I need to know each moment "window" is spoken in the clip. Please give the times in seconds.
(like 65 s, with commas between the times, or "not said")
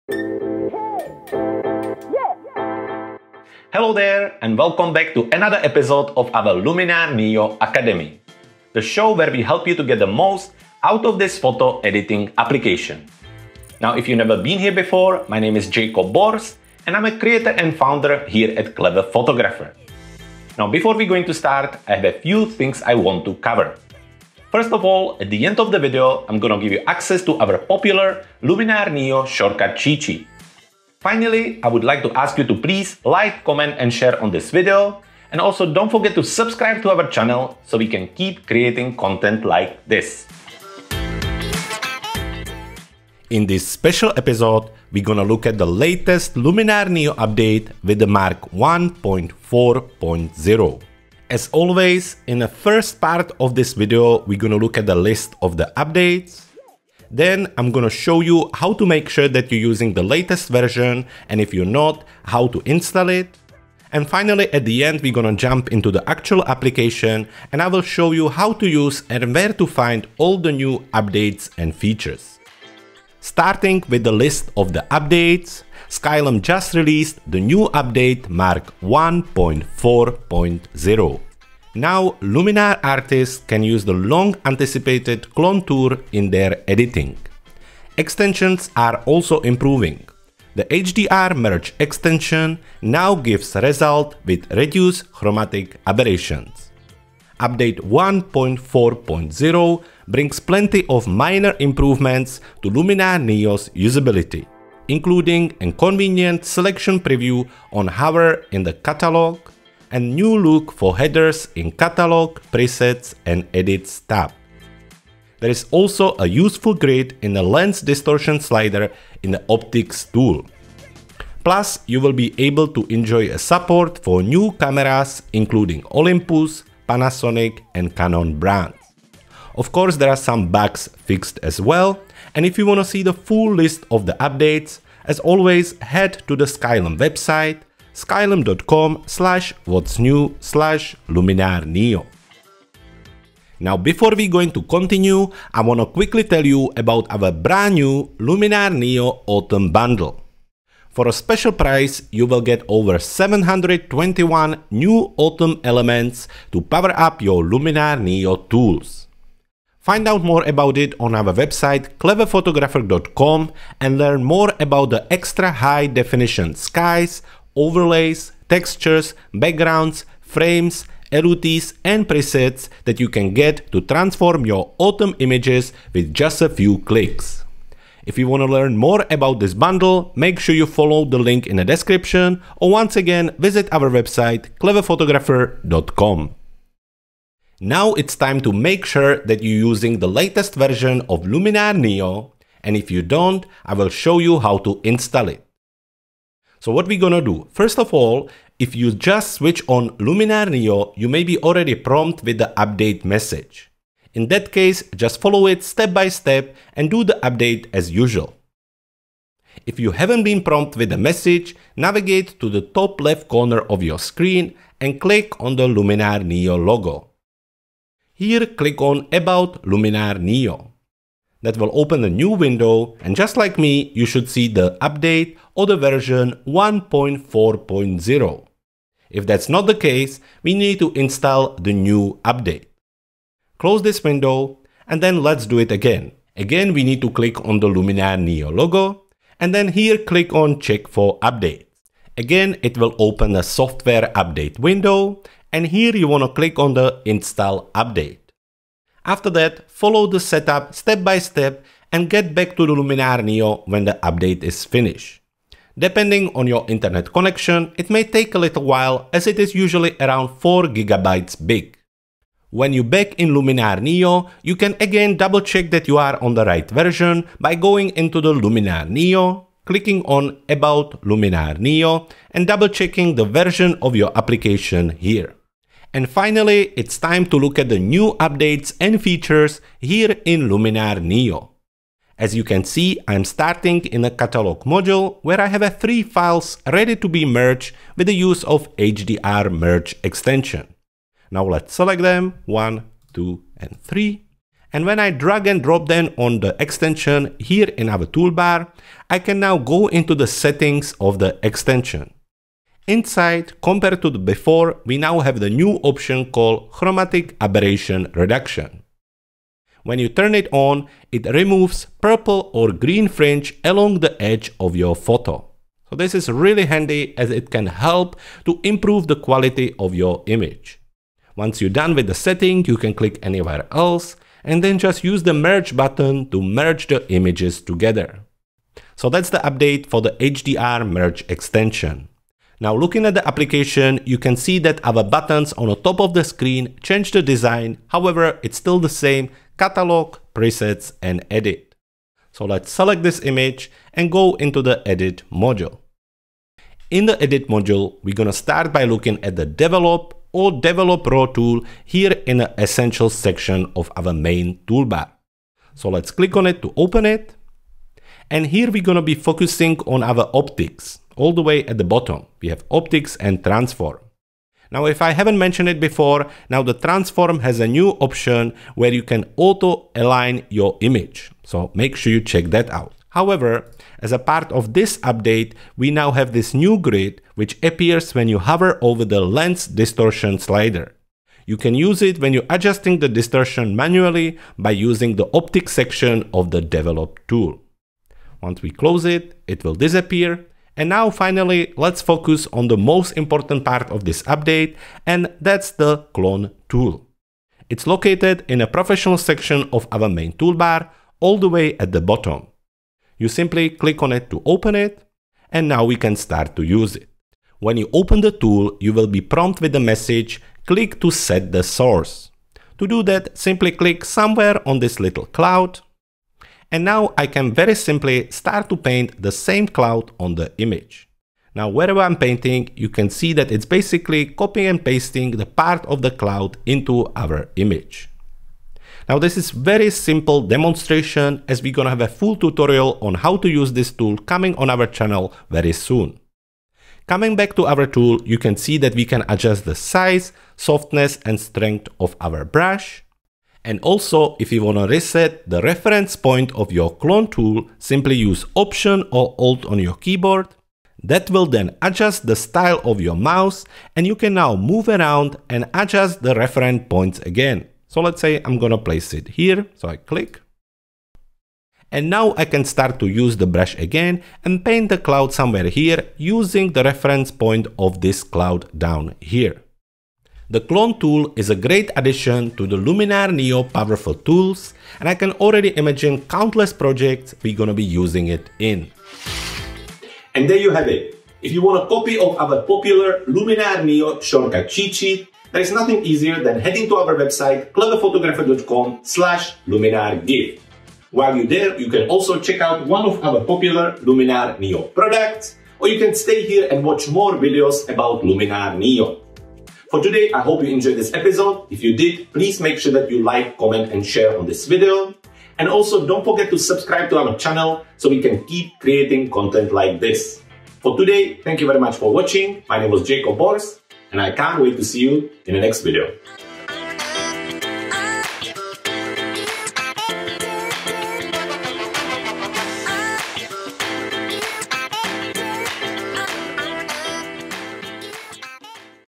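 222 s, 234 s, 244 s.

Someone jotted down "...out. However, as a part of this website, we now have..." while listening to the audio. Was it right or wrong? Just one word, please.
wrong.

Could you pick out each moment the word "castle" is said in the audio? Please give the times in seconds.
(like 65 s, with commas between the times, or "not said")
not said.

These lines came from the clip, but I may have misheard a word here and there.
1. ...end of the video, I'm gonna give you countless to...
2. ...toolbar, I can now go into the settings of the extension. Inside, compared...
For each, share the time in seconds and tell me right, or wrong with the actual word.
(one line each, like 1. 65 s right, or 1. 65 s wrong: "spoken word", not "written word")
1. 25 s wrong: "access", not "countless"
2. 298 s right.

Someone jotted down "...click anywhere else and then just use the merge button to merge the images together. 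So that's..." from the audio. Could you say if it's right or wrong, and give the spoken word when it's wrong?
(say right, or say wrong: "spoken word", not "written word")
right.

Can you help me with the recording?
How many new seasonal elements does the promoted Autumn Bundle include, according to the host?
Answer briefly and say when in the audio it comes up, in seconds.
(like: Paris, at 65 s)
721, at 152 s.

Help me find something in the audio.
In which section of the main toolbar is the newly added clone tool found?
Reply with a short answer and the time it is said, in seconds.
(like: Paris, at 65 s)
professional section, at 398 s.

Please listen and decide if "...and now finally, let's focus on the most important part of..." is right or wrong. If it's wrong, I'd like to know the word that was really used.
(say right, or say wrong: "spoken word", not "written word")
right.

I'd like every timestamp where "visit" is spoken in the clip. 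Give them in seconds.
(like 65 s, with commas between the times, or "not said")
183 s.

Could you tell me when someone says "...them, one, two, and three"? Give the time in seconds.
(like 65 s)
292 s.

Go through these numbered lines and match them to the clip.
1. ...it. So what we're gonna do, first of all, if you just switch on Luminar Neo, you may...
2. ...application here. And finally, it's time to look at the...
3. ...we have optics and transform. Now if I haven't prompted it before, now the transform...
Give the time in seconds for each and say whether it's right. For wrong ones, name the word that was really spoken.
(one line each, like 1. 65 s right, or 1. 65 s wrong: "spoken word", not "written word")
1. 195 s right
2. 274 s right
3. 362 s wrong: "mentioned", not "prompted".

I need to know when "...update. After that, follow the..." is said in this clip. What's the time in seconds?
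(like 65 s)
247 s.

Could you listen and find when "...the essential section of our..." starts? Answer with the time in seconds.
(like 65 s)
352 s.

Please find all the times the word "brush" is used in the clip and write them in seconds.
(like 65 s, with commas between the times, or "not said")
442 s, 463 s.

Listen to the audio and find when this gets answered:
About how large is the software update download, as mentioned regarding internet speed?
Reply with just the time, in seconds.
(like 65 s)
260 s.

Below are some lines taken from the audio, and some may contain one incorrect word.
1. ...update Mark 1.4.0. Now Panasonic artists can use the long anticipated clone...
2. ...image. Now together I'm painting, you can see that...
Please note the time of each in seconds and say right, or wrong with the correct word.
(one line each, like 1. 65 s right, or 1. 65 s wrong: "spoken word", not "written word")
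1. 77 s wrong: "Luminar", not "Panasonic"
2. 420 s wrong: "wherever", not "together".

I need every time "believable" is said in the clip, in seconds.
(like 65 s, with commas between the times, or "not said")
not said.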